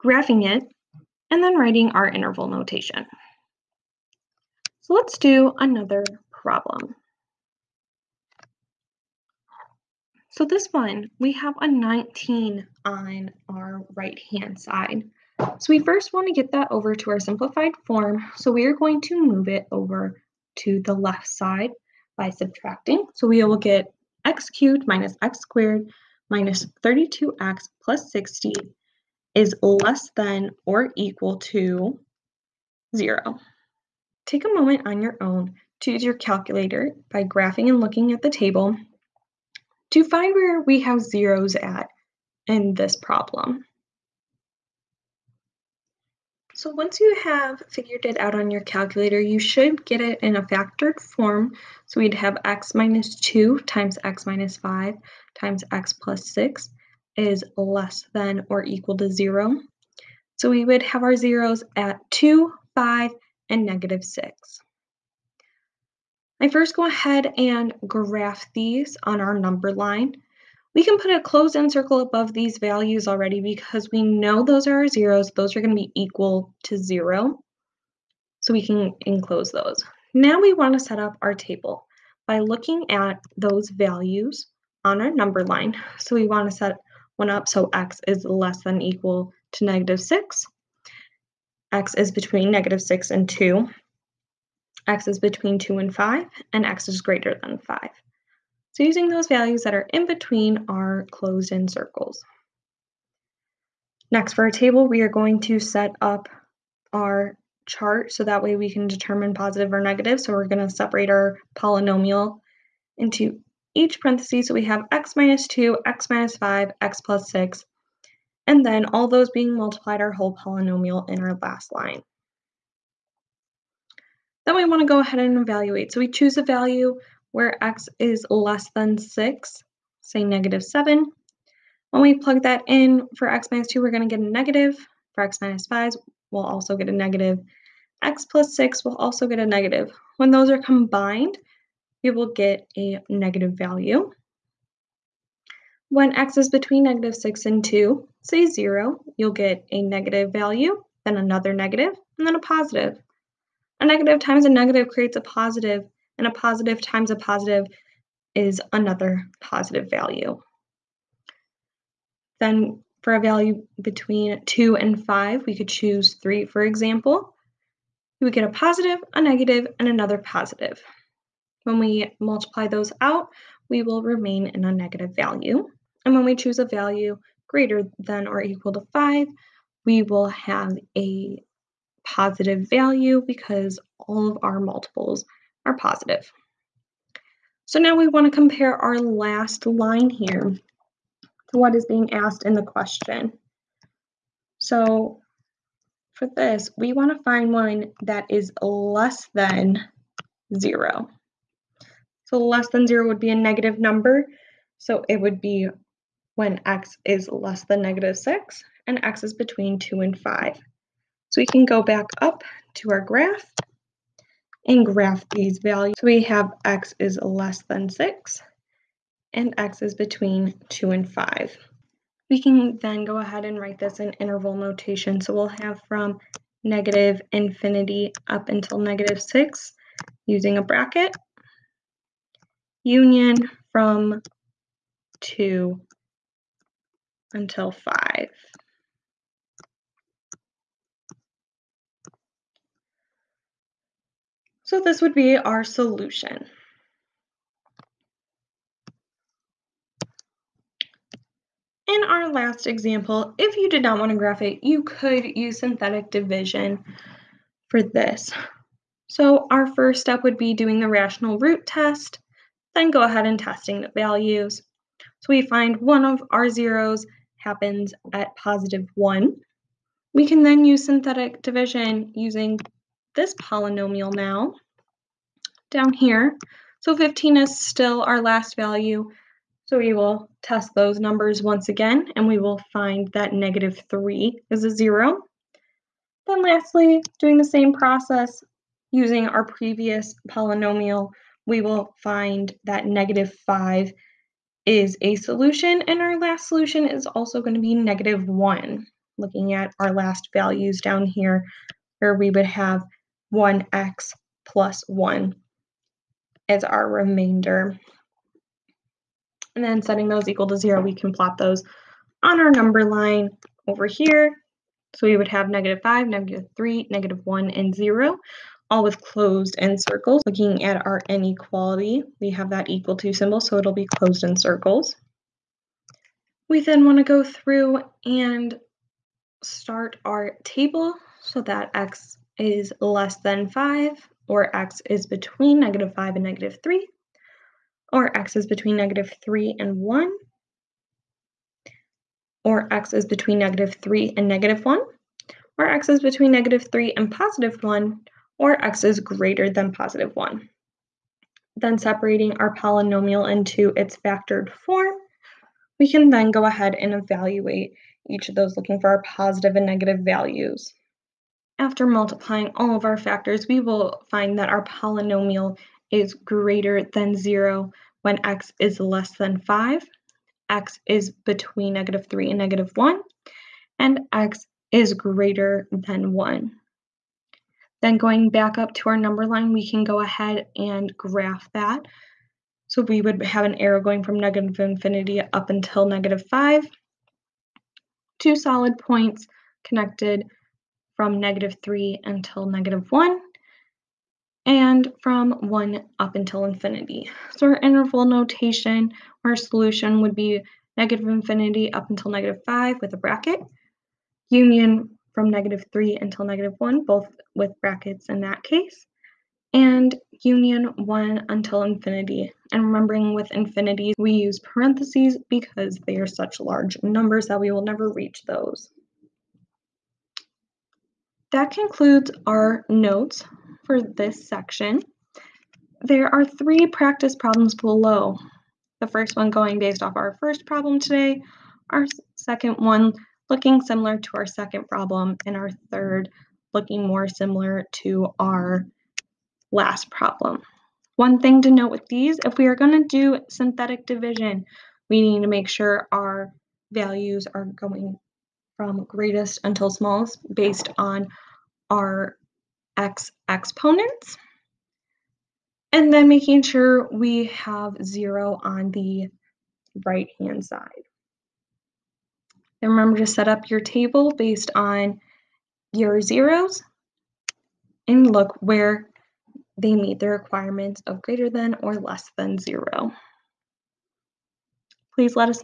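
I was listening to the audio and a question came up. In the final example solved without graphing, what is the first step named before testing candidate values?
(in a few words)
rational root test.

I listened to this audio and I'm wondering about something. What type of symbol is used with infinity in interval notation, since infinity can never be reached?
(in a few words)
parentheses.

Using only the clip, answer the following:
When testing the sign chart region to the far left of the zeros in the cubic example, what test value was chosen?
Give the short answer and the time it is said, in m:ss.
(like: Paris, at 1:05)
-7, at 2:10.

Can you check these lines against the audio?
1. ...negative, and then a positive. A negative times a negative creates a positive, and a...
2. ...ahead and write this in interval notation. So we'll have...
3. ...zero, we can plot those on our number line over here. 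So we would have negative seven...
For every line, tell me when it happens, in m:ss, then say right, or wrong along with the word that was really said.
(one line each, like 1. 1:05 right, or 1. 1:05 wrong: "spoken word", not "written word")
1. 2:31 right
2. 3:43 right
3. 5:10 wrong: "five", not "seven".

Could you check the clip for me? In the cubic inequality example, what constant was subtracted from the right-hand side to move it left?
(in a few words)
19.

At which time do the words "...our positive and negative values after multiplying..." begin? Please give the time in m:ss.
5:58.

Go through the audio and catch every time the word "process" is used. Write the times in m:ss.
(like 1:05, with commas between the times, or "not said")
4:47.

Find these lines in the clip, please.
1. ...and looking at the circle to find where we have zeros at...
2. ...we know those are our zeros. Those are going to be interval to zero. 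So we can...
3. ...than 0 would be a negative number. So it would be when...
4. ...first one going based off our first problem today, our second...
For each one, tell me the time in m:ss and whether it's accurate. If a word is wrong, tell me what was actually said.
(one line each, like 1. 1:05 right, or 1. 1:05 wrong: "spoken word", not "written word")
1. 0:37 wrong: "table", not "circle"
2. 1:13 wrong: "equal", not "interval"
3. 3:22 right
4. 7:08 right.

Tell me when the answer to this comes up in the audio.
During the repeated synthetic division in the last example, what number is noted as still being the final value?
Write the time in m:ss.
4:36.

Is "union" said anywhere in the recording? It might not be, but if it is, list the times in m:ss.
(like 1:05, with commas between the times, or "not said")
3:52, 6:44, 6:50.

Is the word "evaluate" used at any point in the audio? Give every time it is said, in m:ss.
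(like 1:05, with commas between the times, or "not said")
2:05, 5:56.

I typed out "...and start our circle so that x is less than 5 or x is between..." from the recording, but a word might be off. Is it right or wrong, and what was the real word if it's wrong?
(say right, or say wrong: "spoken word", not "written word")
wrong: "table", not "circle".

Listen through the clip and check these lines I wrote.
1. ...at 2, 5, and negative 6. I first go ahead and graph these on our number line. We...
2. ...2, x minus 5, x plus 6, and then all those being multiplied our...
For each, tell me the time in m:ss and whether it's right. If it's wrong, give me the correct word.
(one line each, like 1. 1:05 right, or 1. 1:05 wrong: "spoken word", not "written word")
1. 1:01 right
2. 1:55 right.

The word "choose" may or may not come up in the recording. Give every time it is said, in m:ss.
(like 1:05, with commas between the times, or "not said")
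2:06, 2:45, 2:56.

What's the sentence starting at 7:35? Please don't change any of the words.
And then making sure we have zero on the right hand side.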